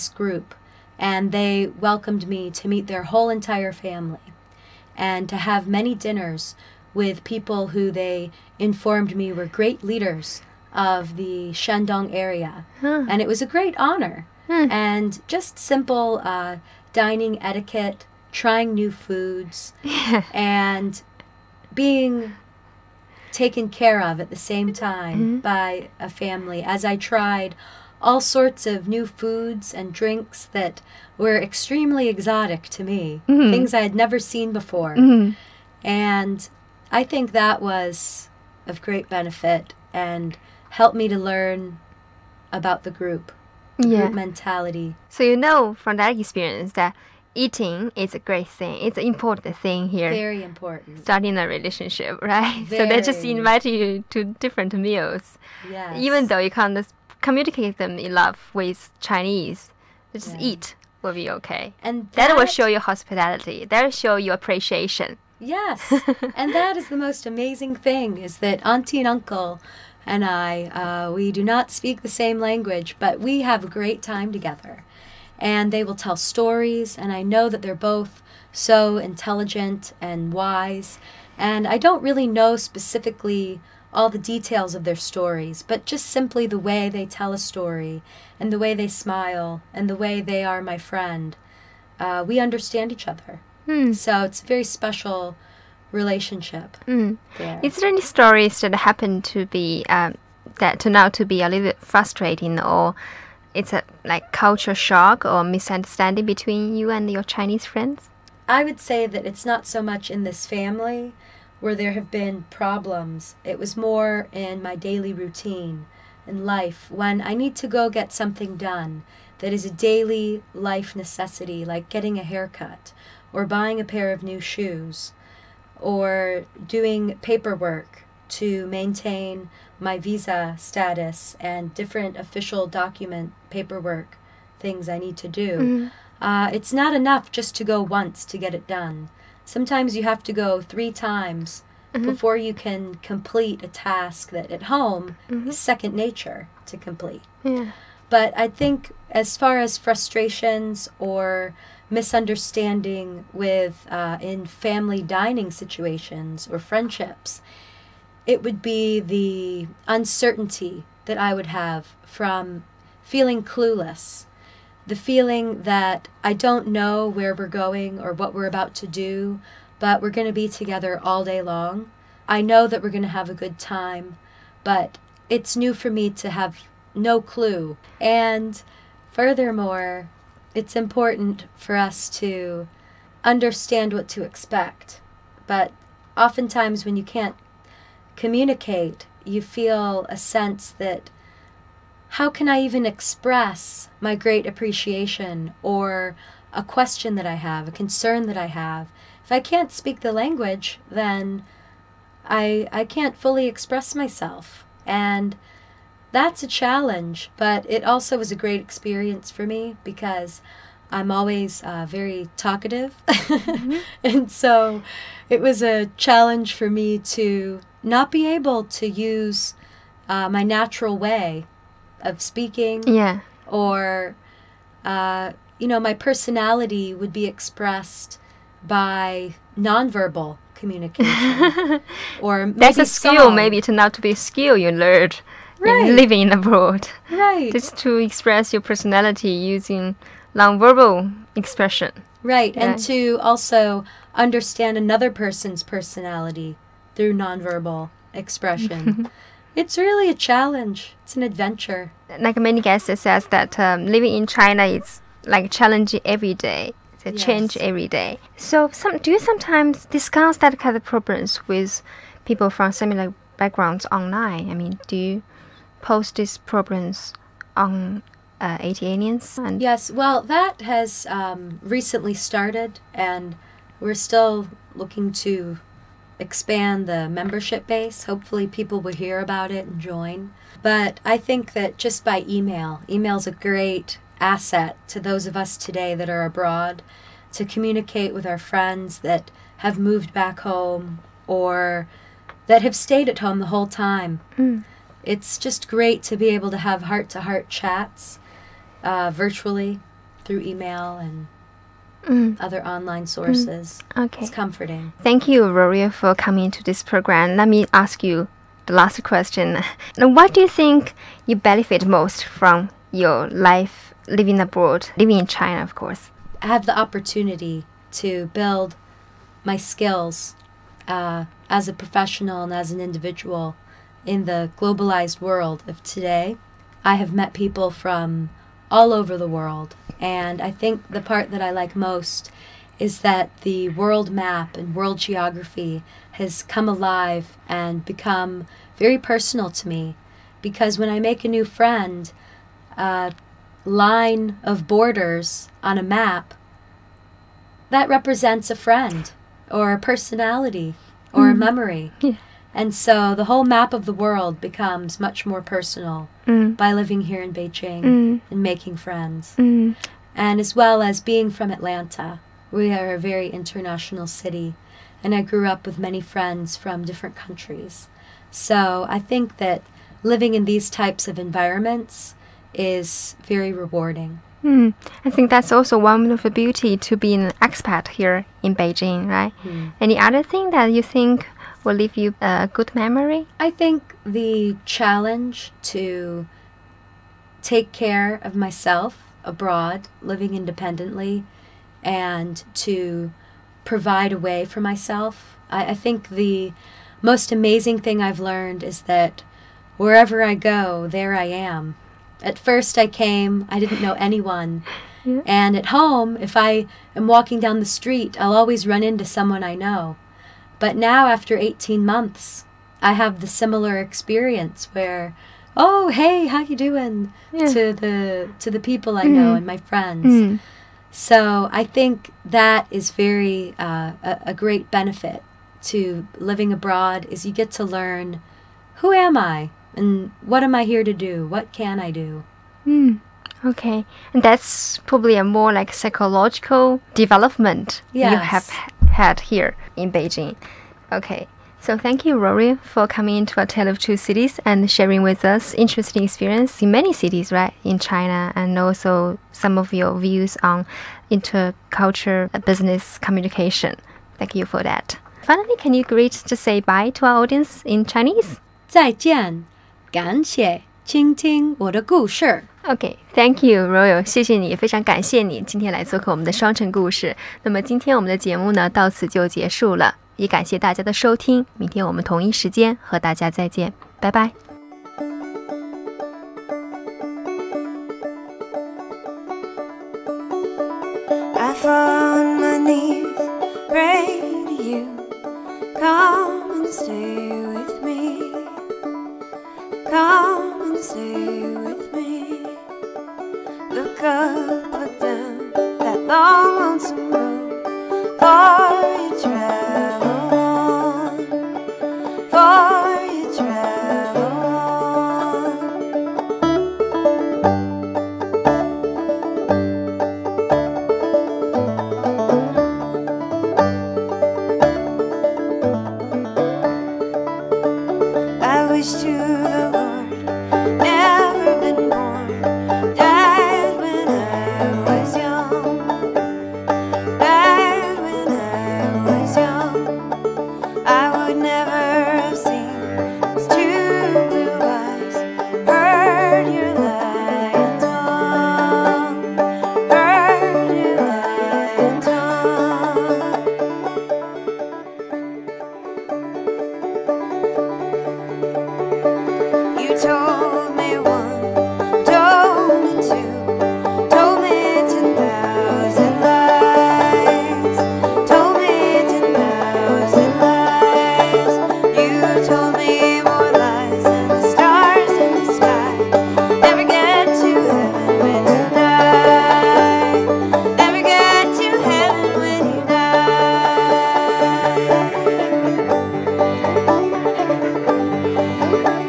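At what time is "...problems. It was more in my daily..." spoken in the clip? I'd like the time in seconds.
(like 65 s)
112 s.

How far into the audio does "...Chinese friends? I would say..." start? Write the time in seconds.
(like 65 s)
107 s.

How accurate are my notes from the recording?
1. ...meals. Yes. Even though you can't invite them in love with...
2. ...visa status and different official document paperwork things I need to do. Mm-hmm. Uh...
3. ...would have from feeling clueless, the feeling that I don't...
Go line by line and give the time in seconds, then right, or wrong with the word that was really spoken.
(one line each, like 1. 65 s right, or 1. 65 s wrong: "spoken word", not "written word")
1. 54 s wrong: "communicate", not "invite"
2. 129 s right
3. 161 s right.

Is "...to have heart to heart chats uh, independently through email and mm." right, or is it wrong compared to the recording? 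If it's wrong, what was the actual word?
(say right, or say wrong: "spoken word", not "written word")
wrong: "virtually", not "independently".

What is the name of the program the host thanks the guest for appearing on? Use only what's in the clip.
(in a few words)
A Tale of Two Cities.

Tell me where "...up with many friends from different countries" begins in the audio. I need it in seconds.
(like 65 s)
365 s.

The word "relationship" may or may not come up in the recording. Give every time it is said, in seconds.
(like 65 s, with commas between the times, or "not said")
51 s, 95 s.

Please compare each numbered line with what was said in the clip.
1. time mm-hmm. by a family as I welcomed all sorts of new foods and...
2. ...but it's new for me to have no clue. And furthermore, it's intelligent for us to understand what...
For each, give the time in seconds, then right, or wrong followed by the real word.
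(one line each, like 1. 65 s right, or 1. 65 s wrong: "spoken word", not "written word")
1. 24 s wrong: "tried", not "welcomed"
2. 174 s wrong: "important", not "intelligent".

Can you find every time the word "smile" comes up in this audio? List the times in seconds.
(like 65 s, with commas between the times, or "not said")
88 s.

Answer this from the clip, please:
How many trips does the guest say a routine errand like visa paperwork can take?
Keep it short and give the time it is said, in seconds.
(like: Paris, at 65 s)
3, at 140 s.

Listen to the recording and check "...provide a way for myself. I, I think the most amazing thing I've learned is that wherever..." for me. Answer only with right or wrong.
right.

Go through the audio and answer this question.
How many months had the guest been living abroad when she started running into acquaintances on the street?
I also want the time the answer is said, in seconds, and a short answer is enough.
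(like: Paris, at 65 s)
18, at 411 s.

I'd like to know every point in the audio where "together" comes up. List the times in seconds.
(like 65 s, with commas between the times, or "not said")
74 s, 170 s.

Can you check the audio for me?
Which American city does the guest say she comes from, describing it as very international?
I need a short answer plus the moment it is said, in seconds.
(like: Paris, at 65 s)
Atlanta, at 361 s.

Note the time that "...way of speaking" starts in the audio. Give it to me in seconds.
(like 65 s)
220 s.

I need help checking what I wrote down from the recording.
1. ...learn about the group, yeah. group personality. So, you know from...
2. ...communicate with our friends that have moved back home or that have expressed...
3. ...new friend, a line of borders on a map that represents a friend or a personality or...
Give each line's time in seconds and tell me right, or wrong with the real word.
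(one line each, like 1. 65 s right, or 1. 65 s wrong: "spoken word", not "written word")
1. 41 s wrong: "mentality", not "personality"
2. 287 s wrong: "stayed", not "expressed"
3. 341 s right.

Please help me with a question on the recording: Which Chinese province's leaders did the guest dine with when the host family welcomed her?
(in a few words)
Shandong.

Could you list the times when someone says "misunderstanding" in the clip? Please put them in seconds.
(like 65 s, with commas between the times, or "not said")
105 s, 151 s.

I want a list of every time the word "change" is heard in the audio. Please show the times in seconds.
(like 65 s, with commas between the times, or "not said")
257 s.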